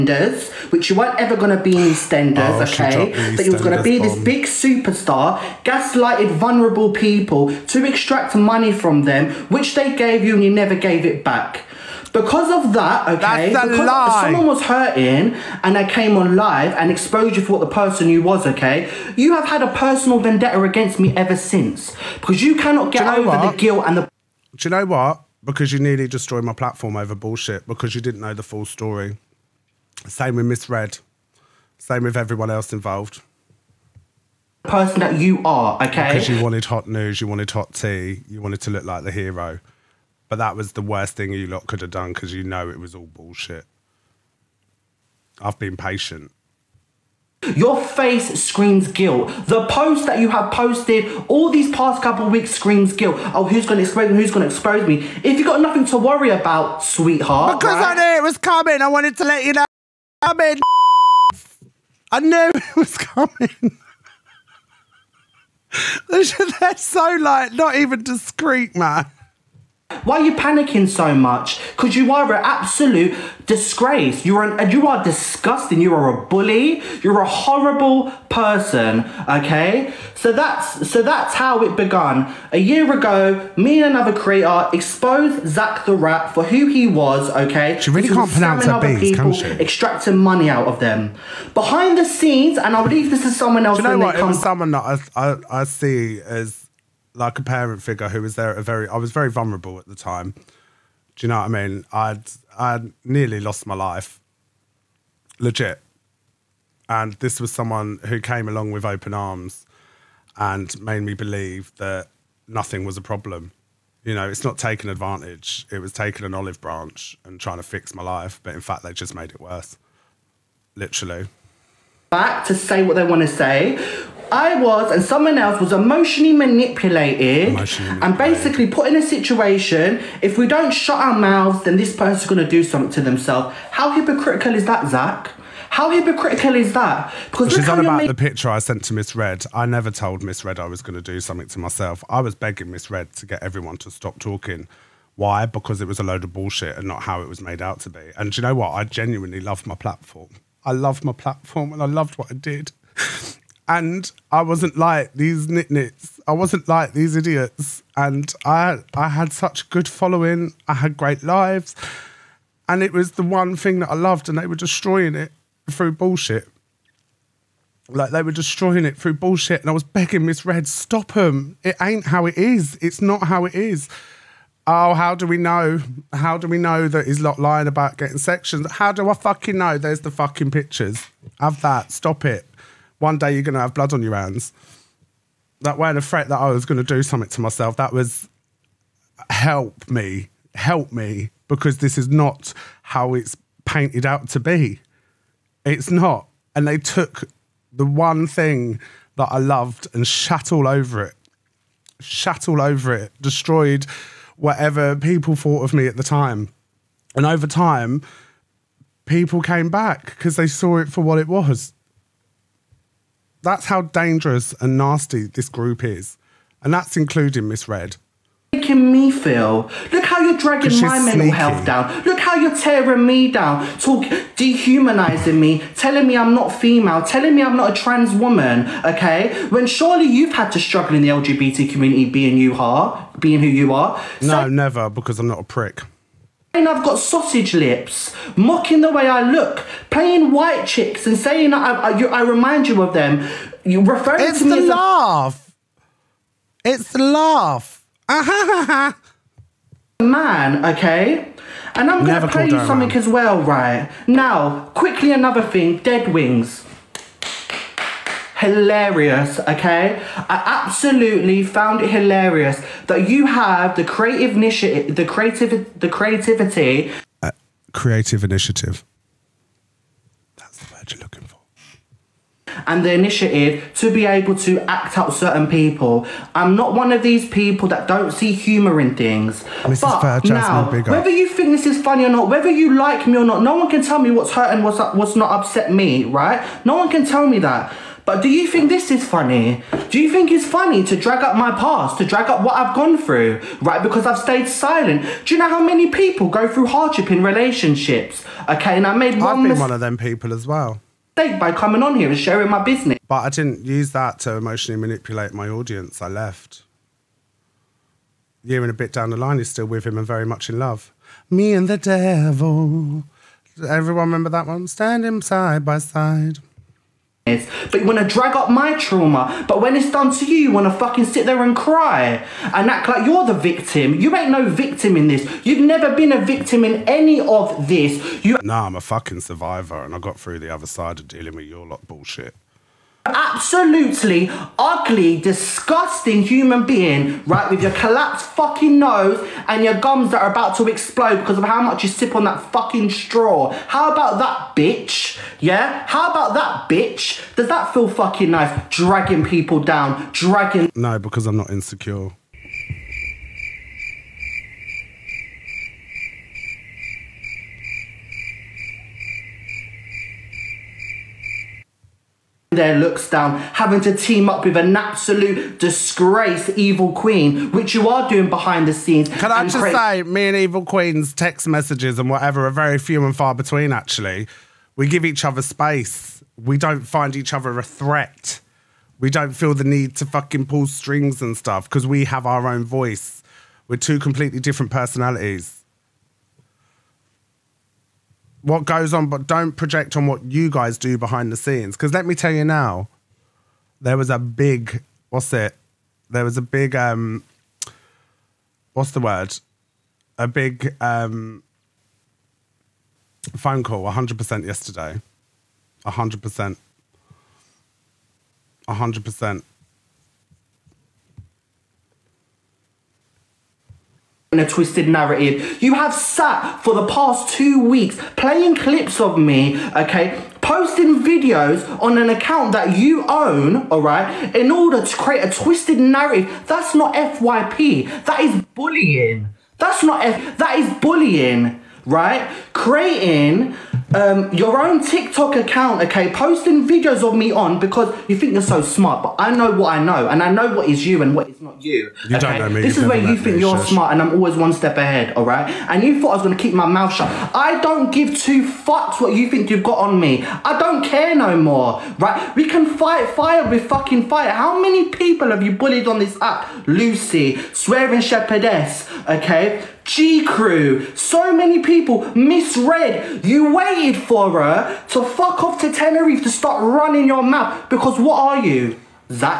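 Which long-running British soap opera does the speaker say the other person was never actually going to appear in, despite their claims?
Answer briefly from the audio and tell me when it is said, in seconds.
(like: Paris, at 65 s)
EastEnders, at 1 s.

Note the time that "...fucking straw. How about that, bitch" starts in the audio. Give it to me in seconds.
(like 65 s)
342 s.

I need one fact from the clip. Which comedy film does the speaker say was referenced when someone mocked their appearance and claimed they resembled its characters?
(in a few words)
White Chicks.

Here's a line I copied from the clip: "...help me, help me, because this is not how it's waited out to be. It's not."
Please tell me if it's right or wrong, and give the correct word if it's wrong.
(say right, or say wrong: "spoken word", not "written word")
wrong: "painted", not "waited".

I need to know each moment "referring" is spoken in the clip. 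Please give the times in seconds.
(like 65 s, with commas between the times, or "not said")
243 s.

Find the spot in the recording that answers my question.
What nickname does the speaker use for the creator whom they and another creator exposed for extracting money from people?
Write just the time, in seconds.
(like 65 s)
85 s.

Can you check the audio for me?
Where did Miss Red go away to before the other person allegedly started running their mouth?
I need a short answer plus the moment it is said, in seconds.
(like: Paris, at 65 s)
Tenerife, at 465 s.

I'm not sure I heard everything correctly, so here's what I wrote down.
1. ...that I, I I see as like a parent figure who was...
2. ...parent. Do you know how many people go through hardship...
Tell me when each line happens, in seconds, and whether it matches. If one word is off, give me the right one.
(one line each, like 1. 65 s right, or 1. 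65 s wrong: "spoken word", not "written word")
1. 94 s right
2. 294 s wrong: "silent", not "parent".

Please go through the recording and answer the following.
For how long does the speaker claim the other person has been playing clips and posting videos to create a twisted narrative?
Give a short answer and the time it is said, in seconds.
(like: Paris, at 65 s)
2 weeks, at 417 s.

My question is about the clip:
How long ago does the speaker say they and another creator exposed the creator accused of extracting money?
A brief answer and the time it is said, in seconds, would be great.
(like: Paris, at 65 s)
A year ago, at 82 s.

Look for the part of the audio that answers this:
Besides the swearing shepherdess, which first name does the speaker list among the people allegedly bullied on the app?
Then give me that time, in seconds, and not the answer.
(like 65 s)
456 s.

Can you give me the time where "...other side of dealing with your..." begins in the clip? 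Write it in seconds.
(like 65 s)
330 s.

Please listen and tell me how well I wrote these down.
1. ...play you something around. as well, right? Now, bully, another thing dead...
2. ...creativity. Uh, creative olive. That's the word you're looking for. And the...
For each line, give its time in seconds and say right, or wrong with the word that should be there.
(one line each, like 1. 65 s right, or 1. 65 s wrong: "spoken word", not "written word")
1. 252 s wrong: "quickly", not "bully"
2. 265 s wrong: "initiative", not "olive".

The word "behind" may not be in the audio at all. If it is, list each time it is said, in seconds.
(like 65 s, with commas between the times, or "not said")
91 s, 368 s, 390 s.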